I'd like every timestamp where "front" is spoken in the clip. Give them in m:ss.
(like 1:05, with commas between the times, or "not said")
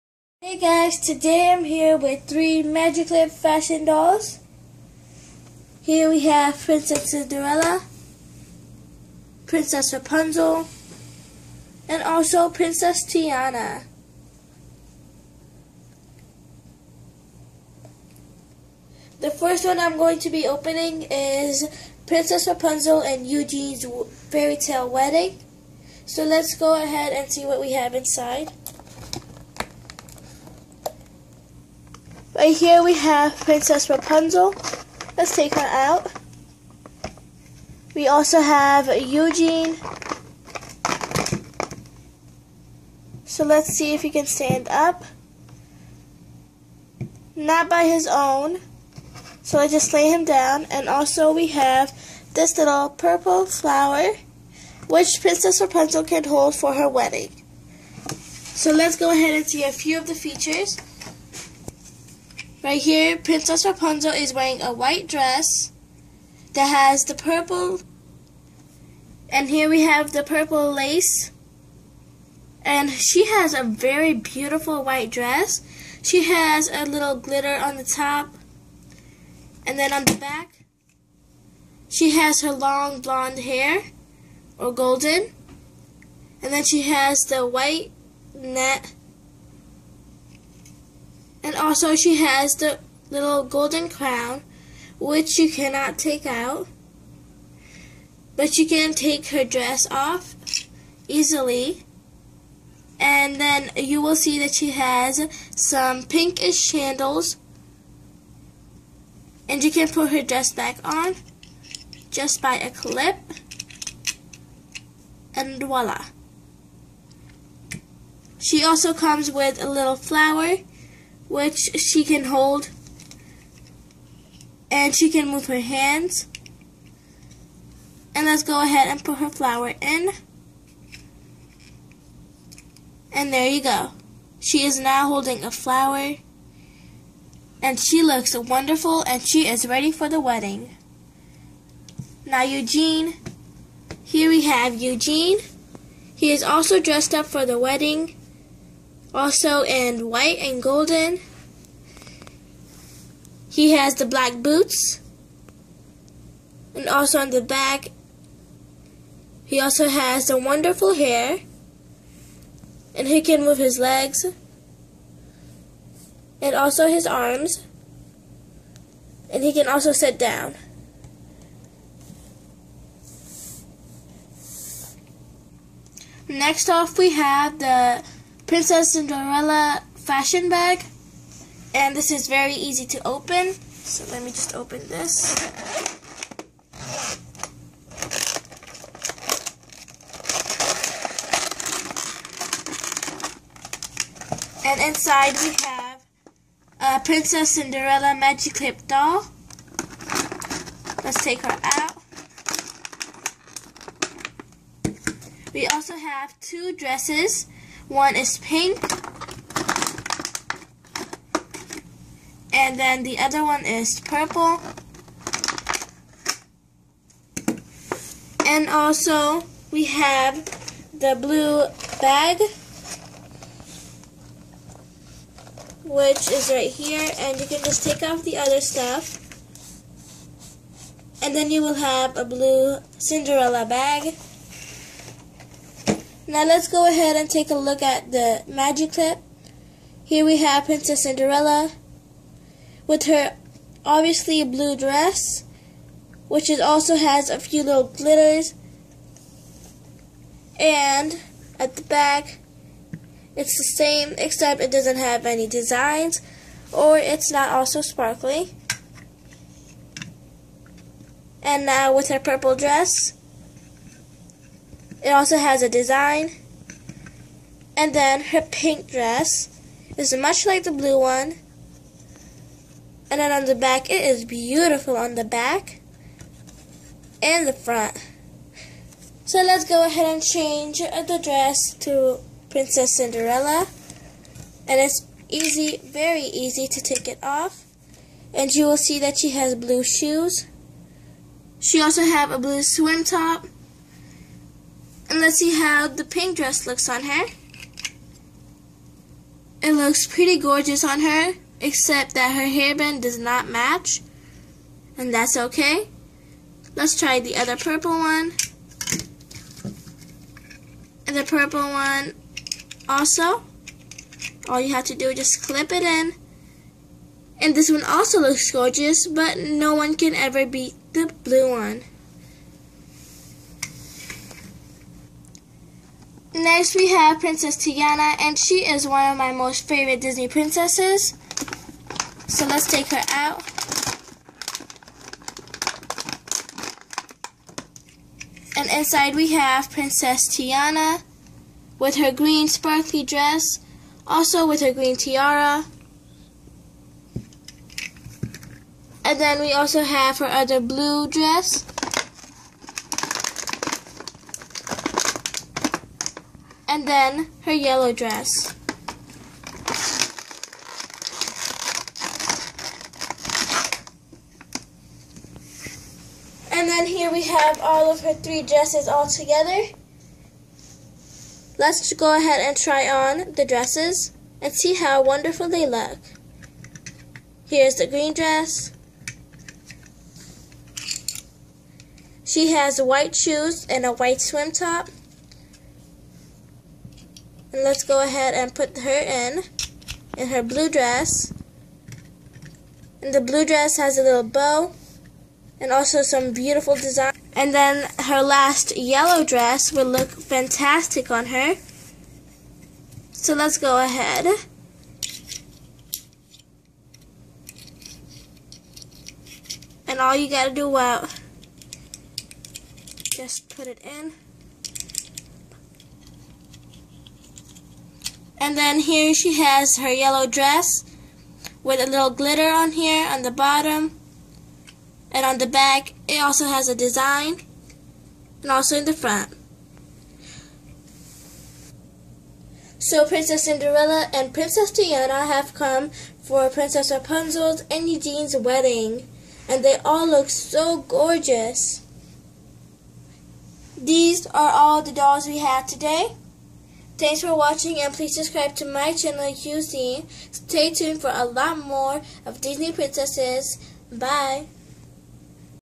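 4:37, 7:08.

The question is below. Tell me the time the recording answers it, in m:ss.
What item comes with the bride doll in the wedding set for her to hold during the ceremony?
0:52.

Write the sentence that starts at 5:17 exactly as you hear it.
And this one also looks gorgeous, but no one can ever beat the blue one.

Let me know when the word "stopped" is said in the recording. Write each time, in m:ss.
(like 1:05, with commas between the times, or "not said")
not said.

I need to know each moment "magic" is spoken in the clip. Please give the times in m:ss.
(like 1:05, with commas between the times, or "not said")
0:02, 3:18, 3:58.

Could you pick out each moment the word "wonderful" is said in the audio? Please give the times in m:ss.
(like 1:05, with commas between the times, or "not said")
2:18, 2:40, 6:15.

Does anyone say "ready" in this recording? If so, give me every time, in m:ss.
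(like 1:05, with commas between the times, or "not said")
2:19.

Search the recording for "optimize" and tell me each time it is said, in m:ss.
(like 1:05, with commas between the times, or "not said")
not said.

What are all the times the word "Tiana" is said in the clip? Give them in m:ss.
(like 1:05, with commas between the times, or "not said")
0:13, 5:27, 5:40, 7:14.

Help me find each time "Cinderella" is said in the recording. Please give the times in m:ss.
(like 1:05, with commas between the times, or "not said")
0:07, 2:58, 3:17, 3:52, 4:01, 4:42, 7:13.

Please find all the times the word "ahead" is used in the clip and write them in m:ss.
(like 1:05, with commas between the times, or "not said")
0:26, 0:59, 2:08, 3:56, 4:39, 6:12, 6:28, 6:43.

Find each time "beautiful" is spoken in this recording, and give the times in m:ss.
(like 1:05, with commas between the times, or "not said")
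1:14, 4:34, 6:36.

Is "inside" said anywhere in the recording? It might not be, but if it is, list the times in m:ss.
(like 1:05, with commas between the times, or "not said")
0:27, 3:14, 5:38.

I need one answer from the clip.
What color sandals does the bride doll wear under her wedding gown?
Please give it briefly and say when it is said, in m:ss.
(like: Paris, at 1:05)
pinkish, at 1:46.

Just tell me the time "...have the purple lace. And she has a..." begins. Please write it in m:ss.
1:09.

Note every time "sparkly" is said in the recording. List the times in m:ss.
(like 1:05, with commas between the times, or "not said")
4:17, 5:42.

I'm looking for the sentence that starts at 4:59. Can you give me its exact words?
It looks pretty gorgeous on her, except that her hairband does not match.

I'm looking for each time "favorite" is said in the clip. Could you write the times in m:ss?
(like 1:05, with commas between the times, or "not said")
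5:29.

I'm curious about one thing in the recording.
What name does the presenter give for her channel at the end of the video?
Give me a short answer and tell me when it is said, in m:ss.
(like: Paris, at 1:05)
QC, at 7:29.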